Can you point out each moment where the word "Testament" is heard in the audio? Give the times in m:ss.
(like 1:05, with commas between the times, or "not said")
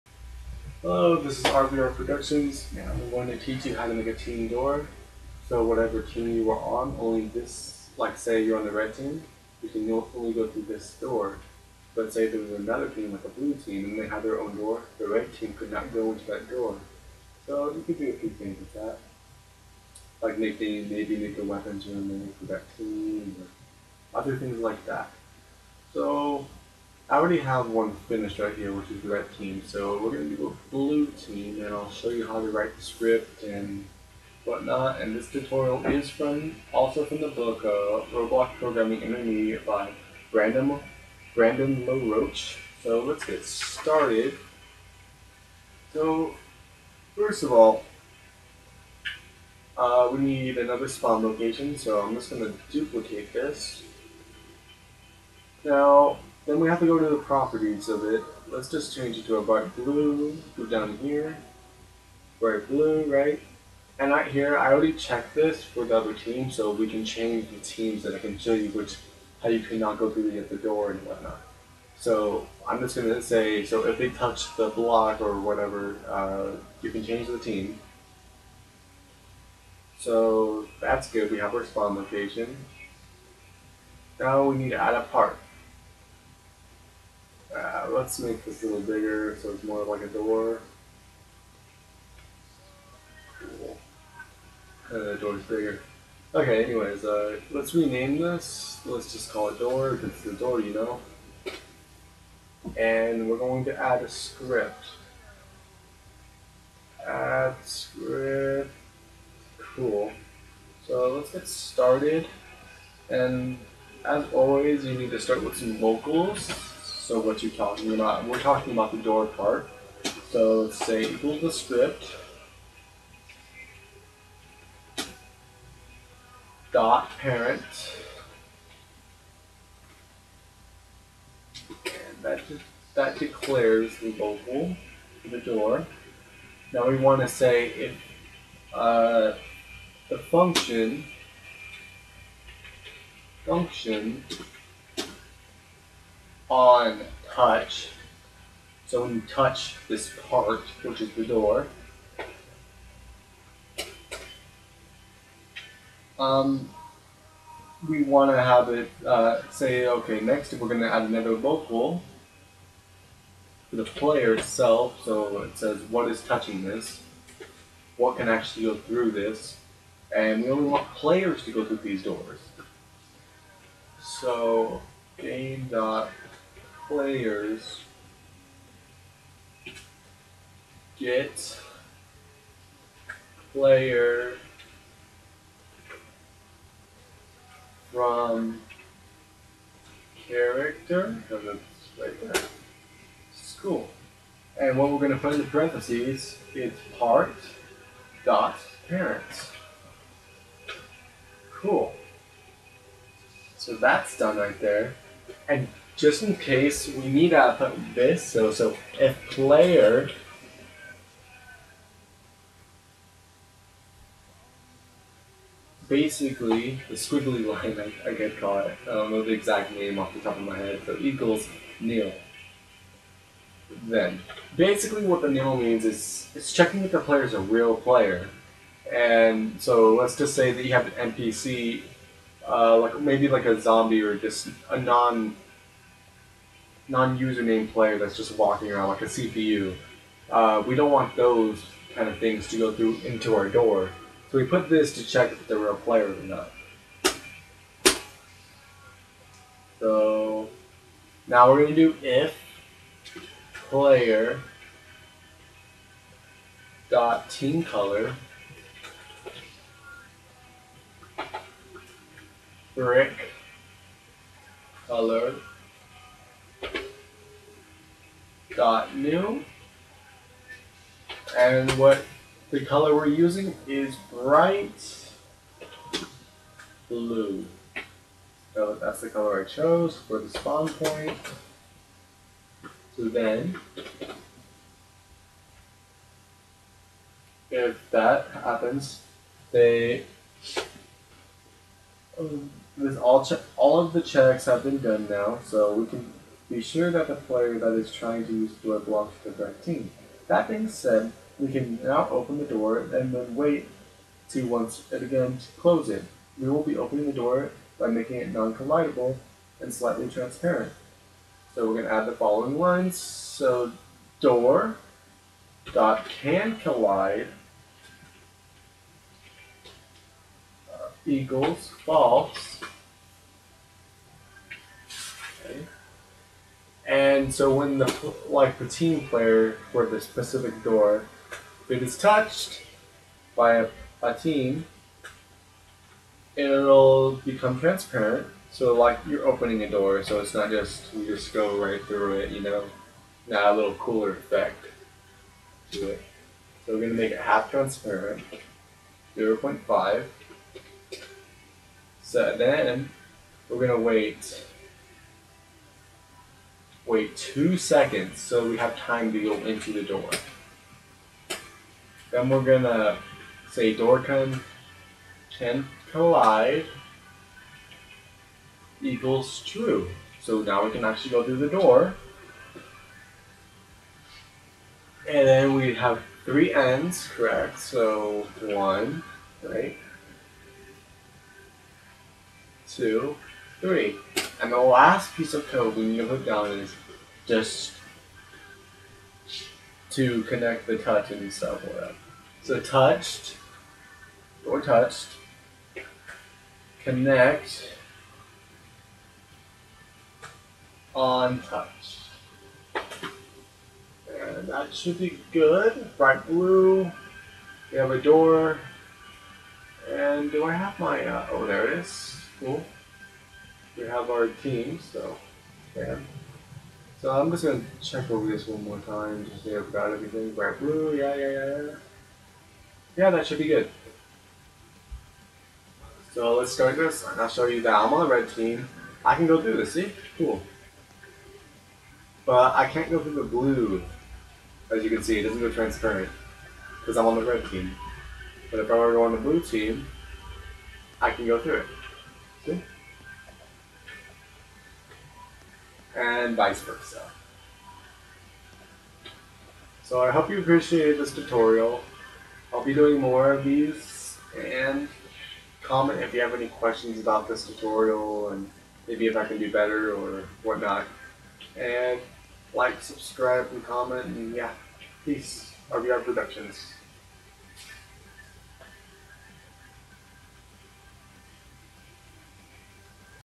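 not said.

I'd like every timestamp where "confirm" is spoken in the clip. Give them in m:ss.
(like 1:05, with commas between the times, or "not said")
not said.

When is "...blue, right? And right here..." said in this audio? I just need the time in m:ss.
1:02.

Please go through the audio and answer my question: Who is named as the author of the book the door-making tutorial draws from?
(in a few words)
Brandon LaRouche.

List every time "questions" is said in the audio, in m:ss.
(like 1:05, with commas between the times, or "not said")
7:36.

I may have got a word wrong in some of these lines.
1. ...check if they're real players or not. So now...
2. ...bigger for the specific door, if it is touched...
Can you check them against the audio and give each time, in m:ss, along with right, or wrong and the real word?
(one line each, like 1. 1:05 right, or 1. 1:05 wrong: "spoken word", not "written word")
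1. 4:05 right
2. 5:29 wrong: "player", not "bigger".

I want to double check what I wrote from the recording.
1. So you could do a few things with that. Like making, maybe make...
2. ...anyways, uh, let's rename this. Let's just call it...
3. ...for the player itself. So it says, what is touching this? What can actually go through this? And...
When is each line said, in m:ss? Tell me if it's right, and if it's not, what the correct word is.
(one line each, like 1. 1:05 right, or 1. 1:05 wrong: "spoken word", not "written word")
1. 0:17 right
2. 1:36 right
3. 2:43 right.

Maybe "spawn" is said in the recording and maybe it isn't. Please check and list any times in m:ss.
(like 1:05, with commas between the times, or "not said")
0:50, 1:21, 4:40.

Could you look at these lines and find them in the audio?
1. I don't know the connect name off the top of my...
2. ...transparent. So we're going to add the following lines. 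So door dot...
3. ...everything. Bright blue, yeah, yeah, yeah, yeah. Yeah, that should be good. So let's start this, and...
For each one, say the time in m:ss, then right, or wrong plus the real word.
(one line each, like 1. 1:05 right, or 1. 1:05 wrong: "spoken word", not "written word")
1. 3:38 wrong: "exact", not "connect"
2. 5:10 right
3. 6:59 right.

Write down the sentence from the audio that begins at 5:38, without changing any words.
So like you're opening a door, so it's not just you just go right through it, you know.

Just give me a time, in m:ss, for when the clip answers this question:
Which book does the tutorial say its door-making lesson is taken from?
0:38.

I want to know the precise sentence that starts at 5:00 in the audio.
That being said, we can now open the door and then wait to once it again close it.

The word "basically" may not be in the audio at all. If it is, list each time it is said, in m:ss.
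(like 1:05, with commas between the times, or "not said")
3:35, 3:44.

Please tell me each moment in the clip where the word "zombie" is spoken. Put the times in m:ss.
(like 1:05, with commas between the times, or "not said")
3:53.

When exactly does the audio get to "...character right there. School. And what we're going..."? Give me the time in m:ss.
3:10.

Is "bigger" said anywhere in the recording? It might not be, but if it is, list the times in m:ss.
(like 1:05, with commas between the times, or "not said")
1:28, 1:35.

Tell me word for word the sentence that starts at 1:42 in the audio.
And we're going to add a script.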